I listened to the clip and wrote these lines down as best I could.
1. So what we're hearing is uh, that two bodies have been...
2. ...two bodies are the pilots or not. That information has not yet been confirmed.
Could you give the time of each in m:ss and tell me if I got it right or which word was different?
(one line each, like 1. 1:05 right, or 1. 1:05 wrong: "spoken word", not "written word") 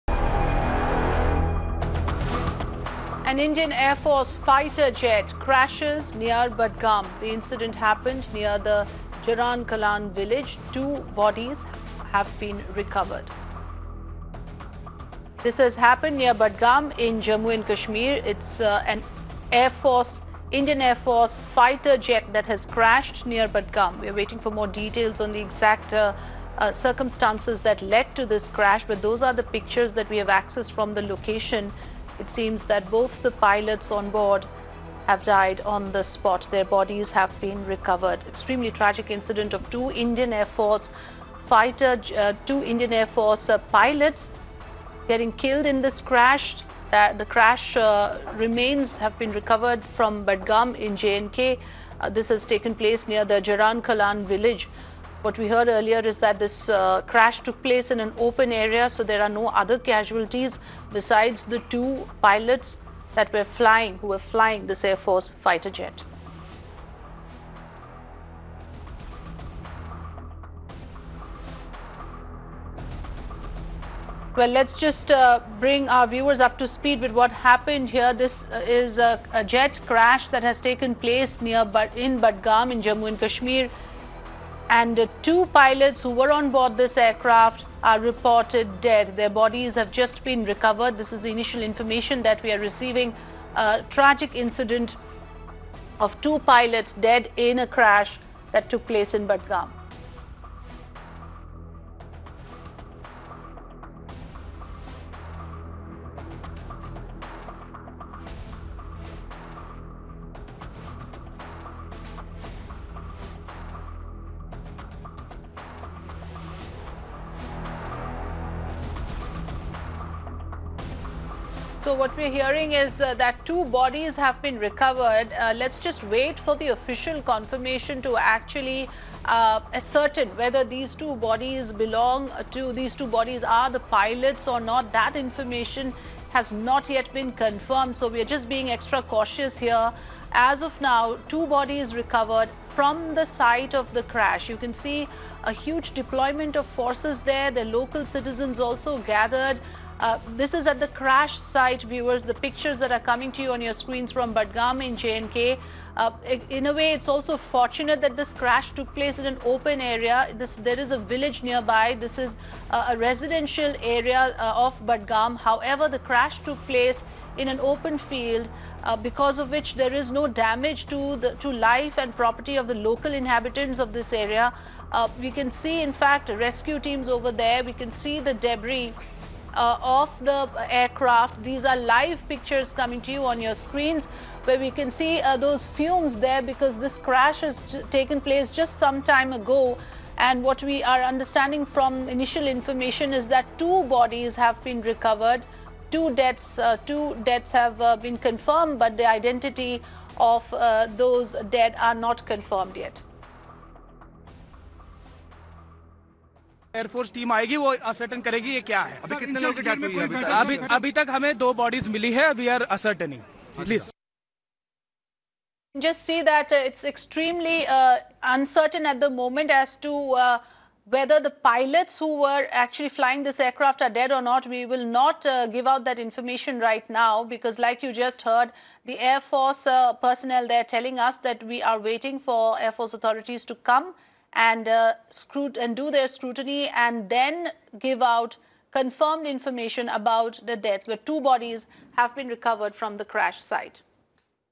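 1. 2:01 right
2. 2:12 right.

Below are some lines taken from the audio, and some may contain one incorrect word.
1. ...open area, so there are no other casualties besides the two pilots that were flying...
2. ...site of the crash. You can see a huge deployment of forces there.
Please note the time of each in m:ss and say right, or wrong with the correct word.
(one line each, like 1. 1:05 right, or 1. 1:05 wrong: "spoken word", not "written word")
1. 0:58 right
2. 2:23 right.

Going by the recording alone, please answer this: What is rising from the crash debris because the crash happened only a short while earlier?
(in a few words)
fumes.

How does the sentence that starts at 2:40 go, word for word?
This, there is a village nearby.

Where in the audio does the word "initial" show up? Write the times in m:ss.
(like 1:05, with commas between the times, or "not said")
1:31, 3:12.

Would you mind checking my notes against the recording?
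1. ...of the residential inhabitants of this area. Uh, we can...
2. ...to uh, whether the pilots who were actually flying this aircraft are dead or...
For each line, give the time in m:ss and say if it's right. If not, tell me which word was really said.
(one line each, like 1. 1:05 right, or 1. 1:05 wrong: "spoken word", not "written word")
1. 2:52 wrong: "local", not "residential"
2. 3:39 right.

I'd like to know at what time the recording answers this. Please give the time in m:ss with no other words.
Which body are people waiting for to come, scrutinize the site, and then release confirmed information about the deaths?
3:52.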